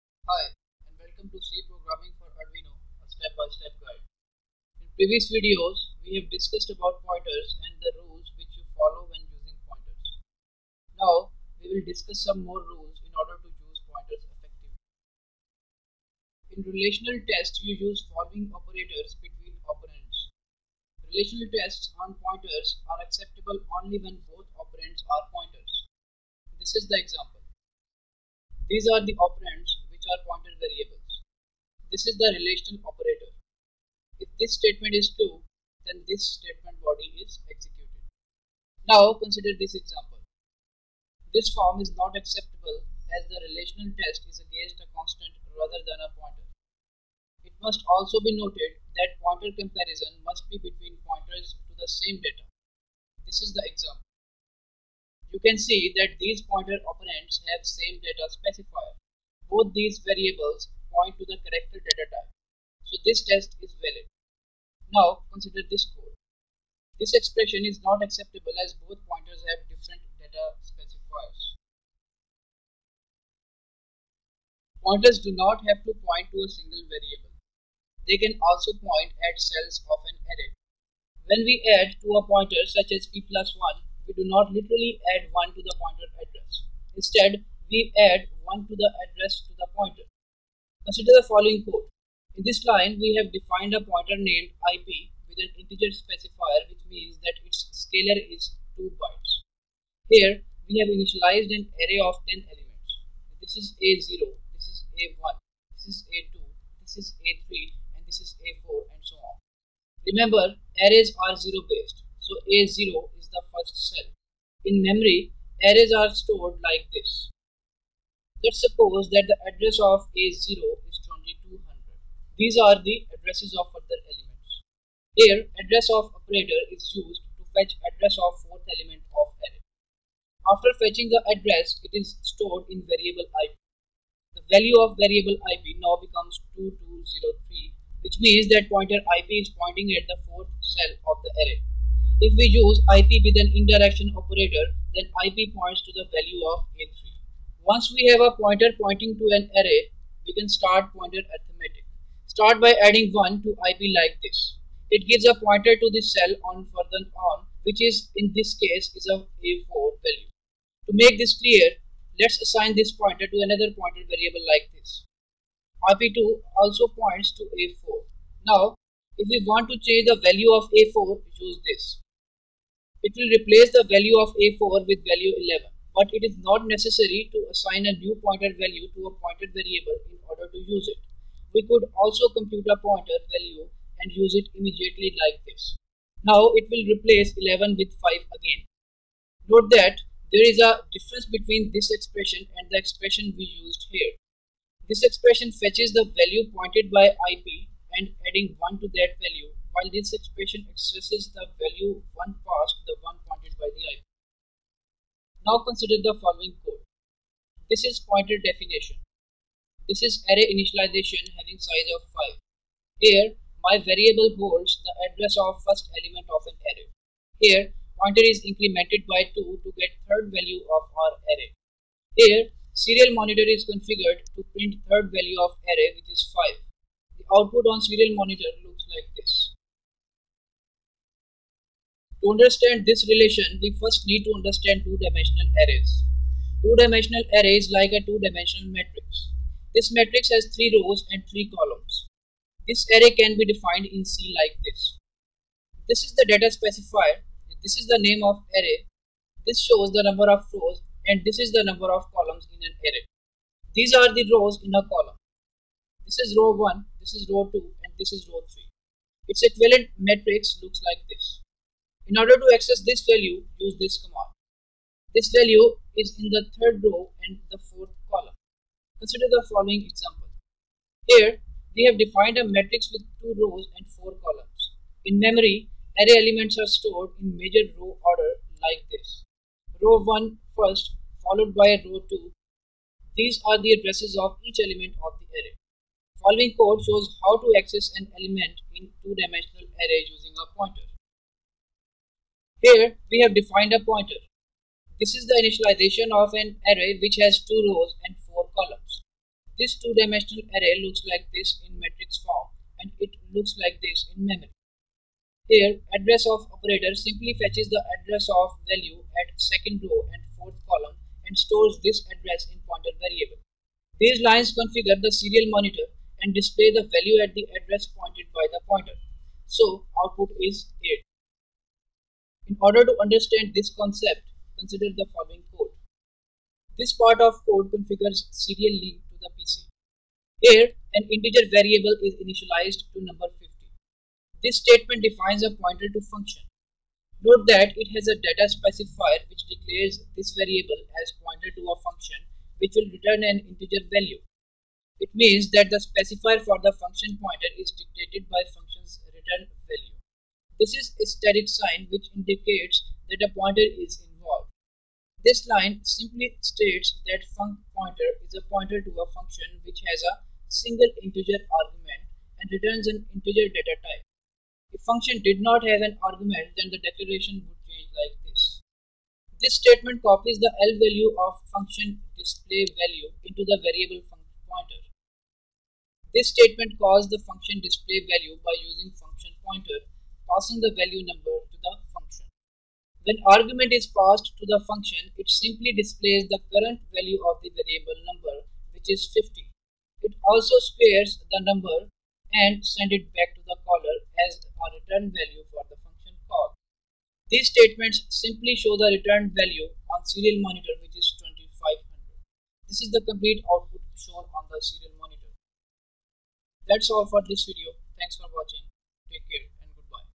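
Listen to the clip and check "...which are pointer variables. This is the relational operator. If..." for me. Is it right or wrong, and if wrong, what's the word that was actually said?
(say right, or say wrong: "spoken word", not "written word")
right.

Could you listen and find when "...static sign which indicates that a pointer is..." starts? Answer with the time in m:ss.
5:51.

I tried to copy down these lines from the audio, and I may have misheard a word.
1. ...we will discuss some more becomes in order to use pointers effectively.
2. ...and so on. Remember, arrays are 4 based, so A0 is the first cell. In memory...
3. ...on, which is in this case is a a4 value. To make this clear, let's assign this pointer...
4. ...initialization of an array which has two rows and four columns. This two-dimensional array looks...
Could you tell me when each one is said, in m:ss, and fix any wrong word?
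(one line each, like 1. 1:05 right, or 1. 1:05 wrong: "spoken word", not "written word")
1. 0:11 wrong: "rules", not "becomes"
2. 1:48 wrong: "0", not "4"
3. 2:37 right
4. 4:55 right.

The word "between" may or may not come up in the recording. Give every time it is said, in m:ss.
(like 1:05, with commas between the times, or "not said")
0:19, 0:50, 3:11.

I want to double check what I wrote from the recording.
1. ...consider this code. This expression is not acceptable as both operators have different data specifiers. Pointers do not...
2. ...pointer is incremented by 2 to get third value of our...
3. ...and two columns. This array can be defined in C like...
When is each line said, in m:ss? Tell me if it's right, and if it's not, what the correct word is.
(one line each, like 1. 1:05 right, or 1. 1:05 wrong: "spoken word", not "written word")
1. 1:05 wrong: "pointers", not "operators"
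2. 3:37 right
3. 4:01 wrong: "three", not "two".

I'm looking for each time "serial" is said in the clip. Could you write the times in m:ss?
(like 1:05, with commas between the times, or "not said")
3:42, 3:47, 5:15, 5:28, 6:40, 6:44.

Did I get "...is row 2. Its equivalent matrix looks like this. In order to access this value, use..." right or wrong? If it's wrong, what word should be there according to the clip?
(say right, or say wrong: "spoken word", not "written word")
wrong: "3", not "2".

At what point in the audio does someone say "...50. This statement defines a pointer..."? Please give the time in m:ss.
5:33.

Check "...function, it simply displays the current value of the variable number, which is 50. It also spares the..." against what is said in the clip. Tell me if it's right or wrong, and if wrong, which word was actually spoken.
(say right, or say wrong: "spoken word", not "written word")
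right.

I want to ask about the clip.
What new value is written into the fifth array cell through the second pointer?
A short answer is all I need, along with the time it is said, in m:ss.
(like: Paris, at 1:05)
11, at 2:55.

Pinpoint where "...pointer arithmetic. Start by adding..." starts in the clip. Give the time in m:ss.
2:30.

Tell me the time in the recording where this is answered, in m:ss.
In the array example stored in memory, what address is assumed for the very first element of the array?
2:01.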